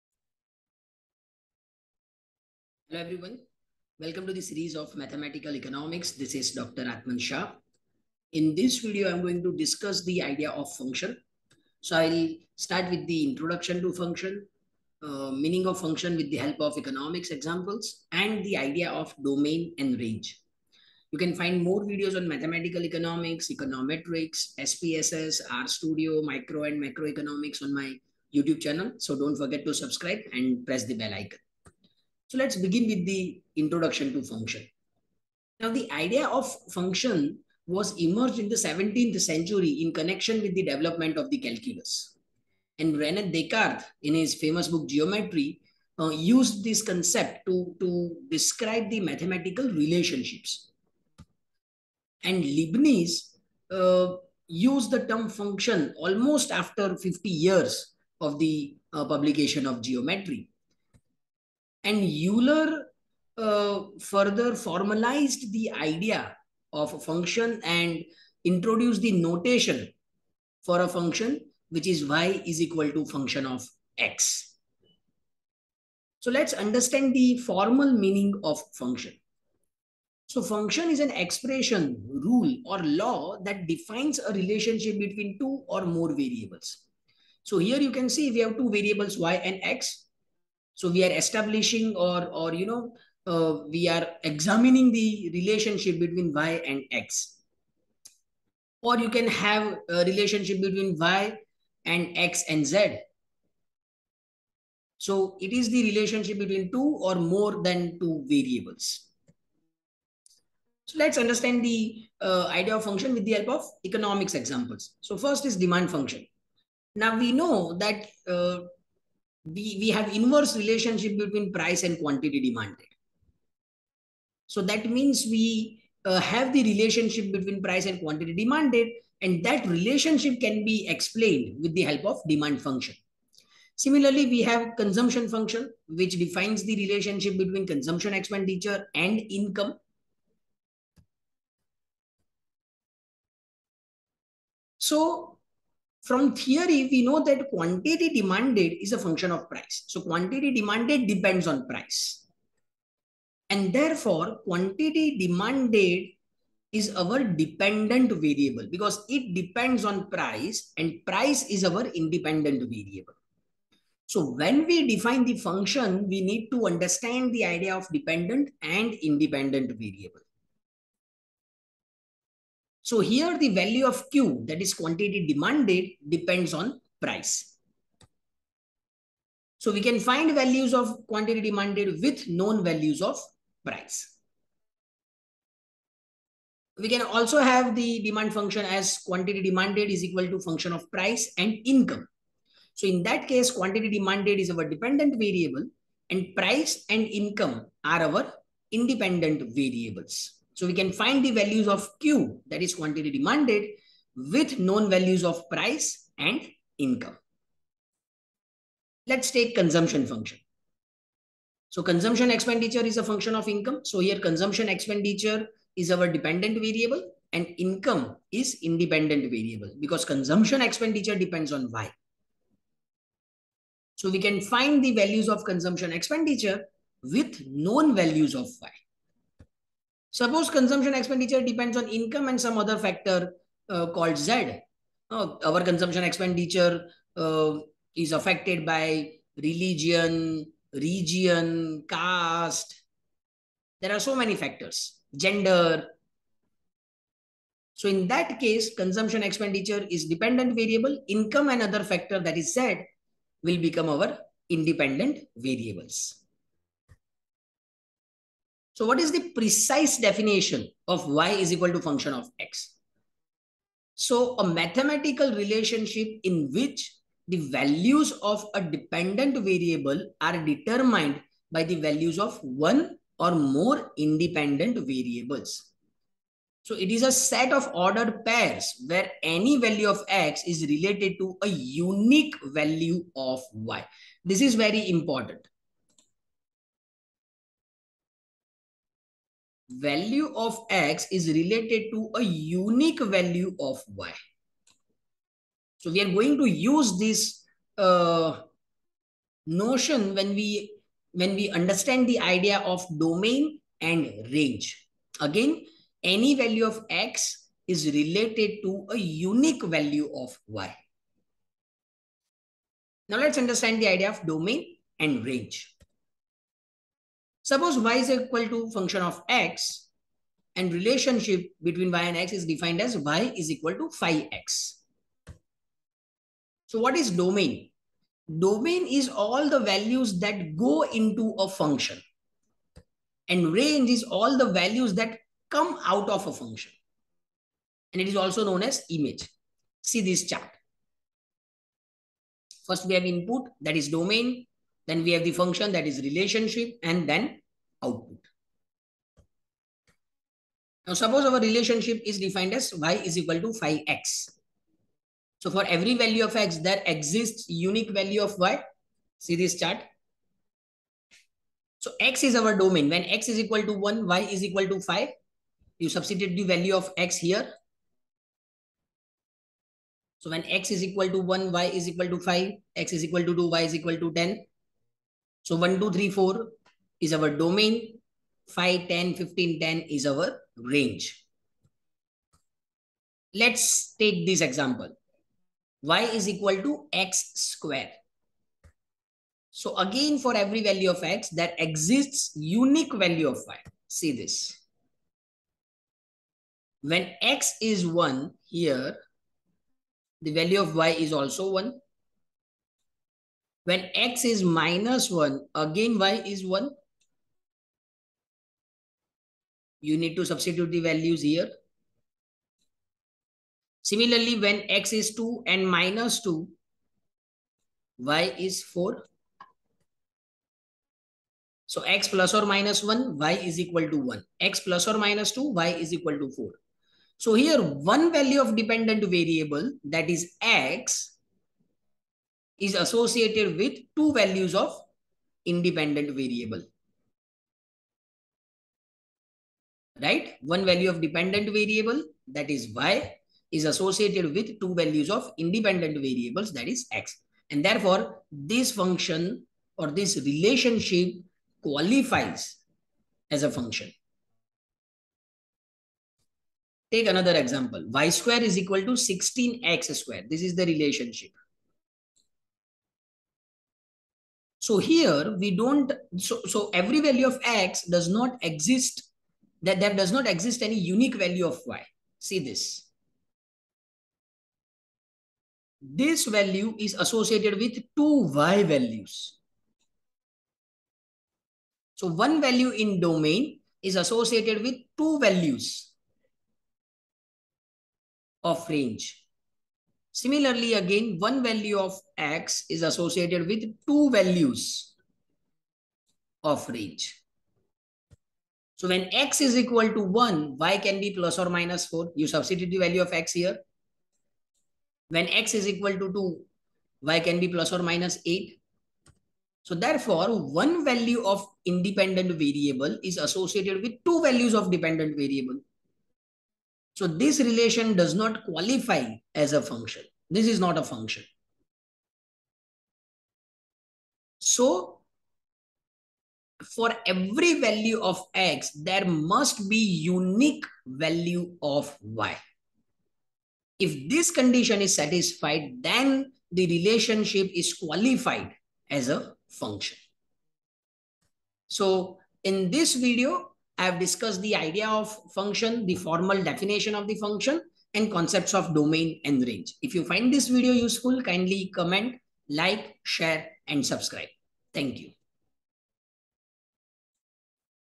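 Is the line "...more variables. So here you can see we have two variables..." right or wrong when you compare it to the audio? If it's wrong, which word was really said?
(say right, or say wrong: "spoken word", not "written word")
right.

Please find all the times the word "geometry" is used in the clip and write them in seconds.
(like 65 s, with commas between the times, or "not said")
44 s, 59 s.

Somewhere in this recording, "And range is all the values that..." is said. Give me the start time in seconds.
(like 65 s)
333 s.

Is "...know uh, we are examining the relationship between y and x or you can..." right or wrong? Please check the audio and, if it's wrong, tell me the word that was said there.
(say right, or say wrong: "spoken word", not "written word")
right.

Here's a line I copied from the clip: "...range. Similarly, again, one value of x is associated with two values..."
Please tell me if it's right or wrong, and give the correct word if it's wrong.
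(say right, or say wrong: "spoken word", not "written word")
right.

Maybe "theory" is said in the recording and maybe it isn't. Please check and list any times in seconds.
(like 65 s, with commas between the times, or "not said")
146 s.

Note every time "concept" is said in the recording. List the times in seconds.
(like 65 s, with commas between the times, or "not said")
46 s, 548 s.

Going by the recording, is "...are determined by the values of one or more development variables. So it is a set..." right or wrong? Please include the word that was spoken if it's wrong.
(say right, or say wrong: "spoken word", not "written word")
wrong: "independent", not "development".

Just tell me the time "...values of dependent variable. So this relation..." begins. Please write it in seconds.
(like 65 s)
514 s.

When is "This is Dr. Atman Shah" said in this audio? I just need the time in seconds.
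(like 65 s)
6 s.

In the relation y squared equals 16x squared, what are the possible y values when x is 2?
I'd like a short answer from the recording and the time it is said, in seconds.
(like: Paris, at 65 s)
plus or minus 8, at 507 s.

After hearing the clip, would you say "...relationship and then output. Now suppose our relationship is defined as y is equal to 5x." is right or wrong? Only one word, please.
right.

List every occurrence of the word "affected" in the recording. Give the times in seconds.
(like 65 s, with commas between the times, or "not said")
238 s.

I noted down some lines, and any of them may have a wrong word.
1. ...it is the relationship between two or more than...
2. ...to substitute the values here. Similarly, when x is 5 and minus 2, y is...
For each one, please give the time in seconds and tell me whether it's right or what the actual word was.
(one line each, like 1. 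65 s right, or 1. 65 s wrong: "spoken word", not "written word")
1. 105 s right
2. 410 s wrong: "2", not "5".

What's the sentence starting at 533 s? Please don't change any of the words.
If this condition is satisfied, then the relationship is qualified as a function.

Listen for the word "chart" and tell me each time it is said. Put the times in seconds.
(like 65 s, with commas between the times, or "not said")
340 s, 359 s.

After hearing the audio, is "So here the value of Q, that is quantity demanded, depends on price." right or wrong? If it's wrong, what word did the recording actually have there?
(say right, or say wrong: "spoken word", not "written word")
right.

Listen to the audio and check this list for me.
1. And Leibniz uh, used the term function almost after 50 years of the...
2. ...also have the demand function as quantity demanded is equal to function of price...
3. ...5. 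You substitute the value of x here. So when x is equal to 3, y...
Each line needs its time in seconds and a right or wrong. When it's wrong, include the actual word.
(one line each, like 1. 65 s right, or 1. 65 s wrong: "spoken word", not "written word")
1. 52 s right
2. 187 s right
3. 364 s wrong: "1", not "3".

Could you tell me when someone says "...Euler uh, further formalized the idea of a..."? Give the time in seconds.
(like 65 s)
62 s.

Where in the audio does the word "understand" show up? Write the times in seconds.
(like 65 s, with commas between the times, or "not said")
76 s, 111 s, 166 s, 301 s, 313 s.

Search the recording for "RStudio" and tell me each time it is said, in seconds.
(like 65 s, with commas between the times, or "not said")
25 s.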